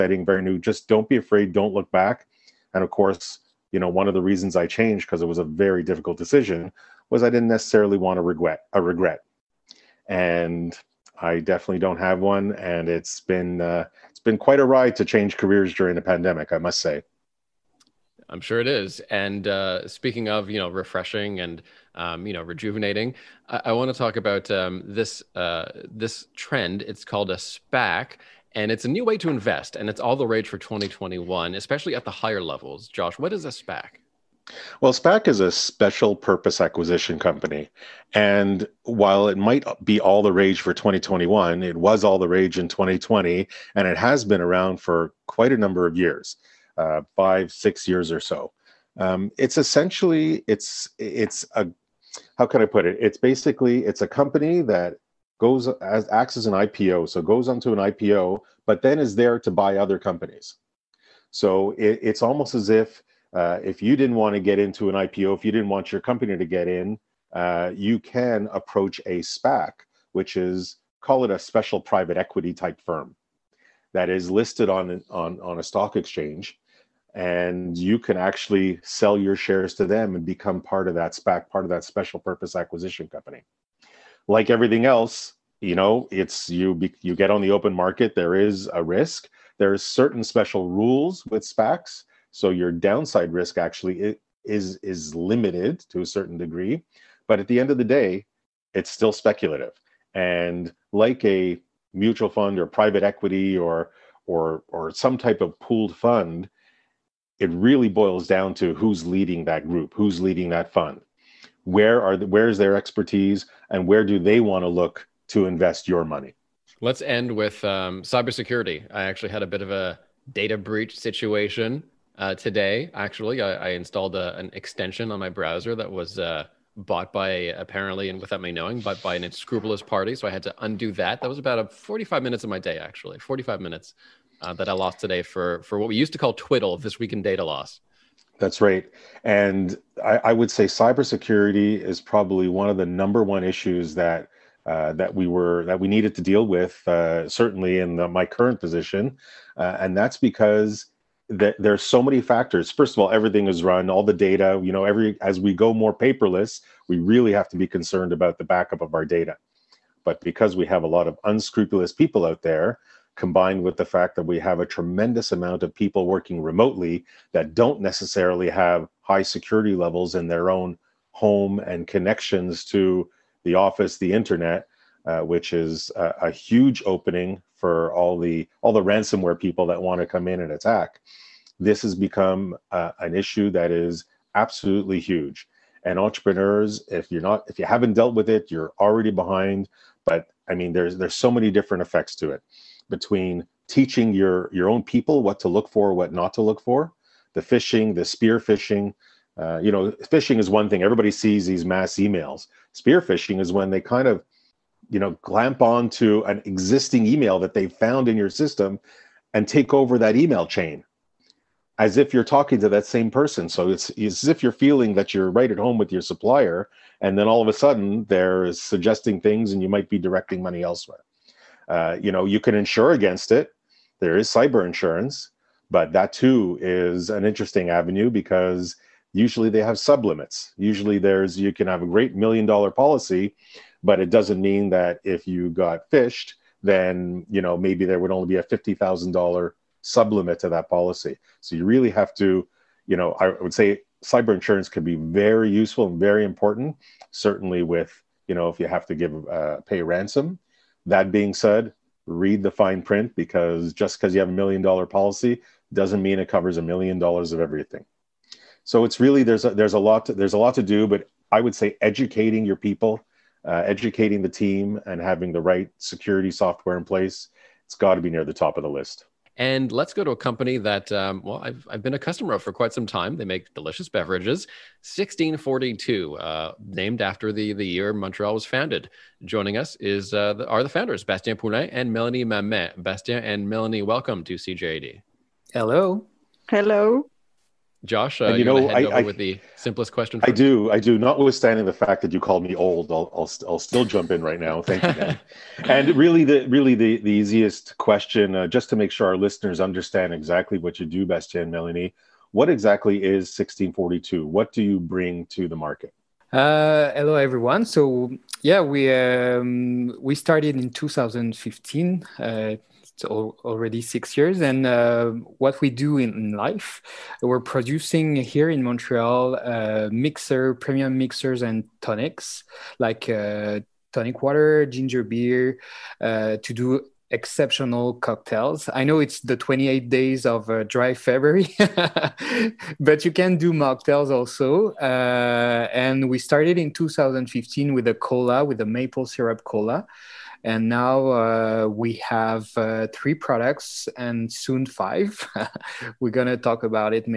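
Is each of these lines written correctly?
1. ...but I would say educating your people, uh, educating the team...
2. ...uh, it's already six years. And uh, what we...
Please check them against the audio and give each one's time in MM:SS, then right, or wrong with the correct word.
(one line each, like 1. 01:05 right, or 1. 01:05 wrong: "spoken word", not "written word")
1. 04:20 right
2. 05:12 right.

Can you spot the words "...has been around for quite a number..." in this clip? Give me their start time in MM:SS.
00:43.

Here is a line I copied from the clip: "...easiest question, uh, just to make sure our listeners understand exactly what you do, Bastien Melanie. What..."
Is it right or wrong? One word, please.
right.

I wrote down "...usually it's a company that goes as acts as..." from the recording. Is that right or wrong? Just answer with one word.
wrong.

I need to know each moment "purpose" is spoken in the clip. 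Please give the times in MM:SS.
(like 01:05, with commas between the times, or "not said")
00:36, 01:22.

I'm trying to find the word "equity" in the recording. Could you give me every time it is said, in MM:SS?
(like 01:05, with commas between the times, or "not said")
01:12, 01:43.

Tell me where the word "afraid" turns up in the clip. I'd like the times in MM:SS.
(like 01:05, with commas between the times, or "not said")
00:01.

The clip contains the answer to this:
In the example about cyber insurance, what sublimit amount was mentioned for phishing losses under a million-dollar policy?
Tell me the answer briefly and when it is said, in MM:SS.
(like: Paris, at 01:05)
$50,000, at 03:58.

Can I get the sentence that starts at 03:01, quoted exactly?
This has become uh, an issue that is absolutely huge.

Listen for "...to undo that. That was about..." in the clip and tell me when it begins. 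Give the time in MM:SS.
02:10.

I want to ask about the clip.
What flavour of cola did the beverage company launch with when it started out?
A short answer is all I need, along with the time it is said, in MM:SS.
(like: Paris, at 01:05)
maple syrup cola, at 05:38.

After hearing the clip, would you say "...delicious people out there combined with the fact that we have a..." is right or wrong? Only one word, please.
wrong.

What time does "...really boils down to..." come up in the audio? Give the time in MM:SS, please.
01:47.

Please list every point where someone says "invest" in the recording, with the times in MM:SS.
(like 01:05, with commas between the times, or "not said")
00:29, 01:55.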